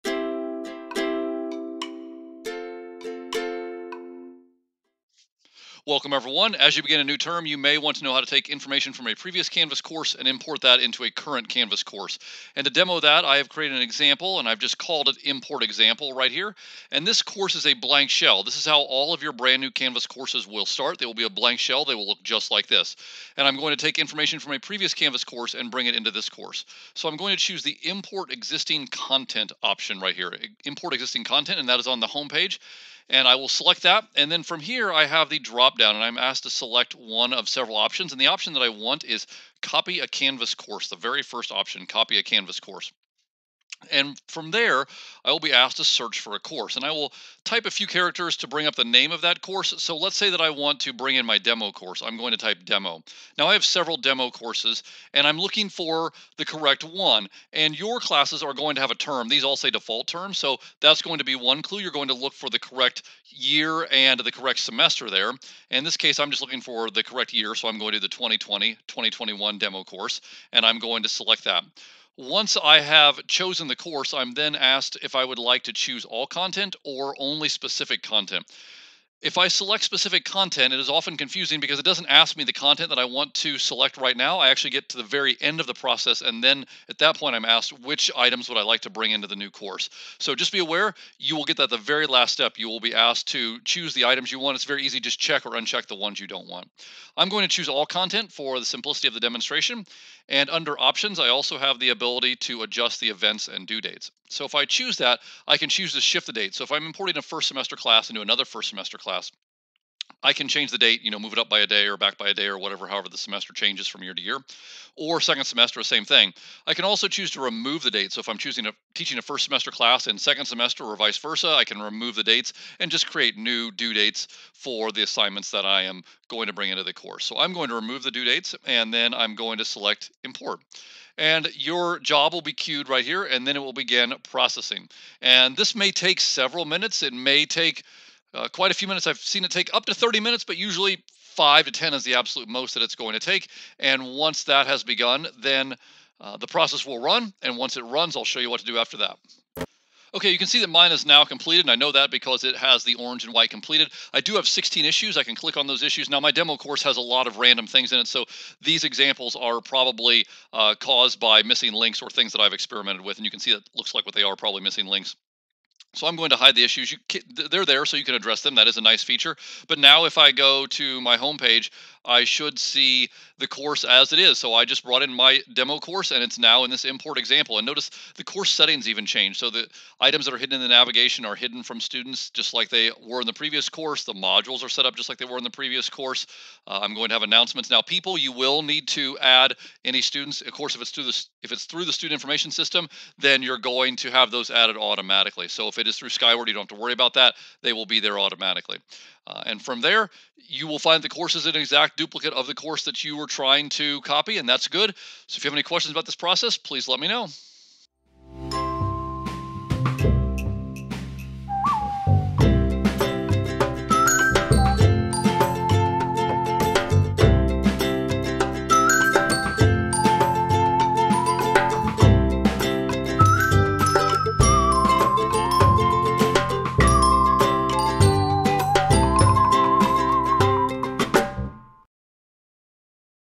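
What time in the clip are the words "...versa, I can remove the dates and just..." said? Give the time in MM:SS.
02:01.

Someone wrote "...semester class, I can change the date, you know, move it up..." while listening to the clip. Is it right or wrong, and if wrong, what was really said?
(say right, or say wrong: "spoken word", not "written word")
right.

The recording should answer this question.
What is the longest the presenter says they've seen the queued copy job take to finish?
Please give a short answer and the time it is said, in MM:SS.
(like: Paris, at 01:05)
30 minutes, at 02:19.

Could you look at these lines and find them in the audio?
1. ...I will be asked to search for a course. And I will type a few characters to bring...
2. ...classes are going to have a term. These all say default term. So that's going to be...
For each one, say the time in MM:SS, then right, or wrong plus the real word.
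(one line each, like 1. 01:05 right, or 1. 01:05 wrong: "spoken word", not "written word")
1. 00:45 right
2. 00:57 right.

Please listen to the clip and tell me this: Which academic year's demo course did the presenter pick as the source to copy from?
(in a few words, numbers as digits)
2020-2021.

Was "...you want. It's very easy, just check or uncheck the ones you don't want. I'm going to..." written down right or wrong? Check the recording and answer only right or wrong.
right.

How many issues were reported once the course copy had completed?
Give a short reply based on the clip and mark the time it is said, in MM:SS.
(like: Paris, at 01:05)
16, at 02:34.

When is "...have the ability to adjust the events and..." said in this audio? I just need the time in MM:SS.
01:41.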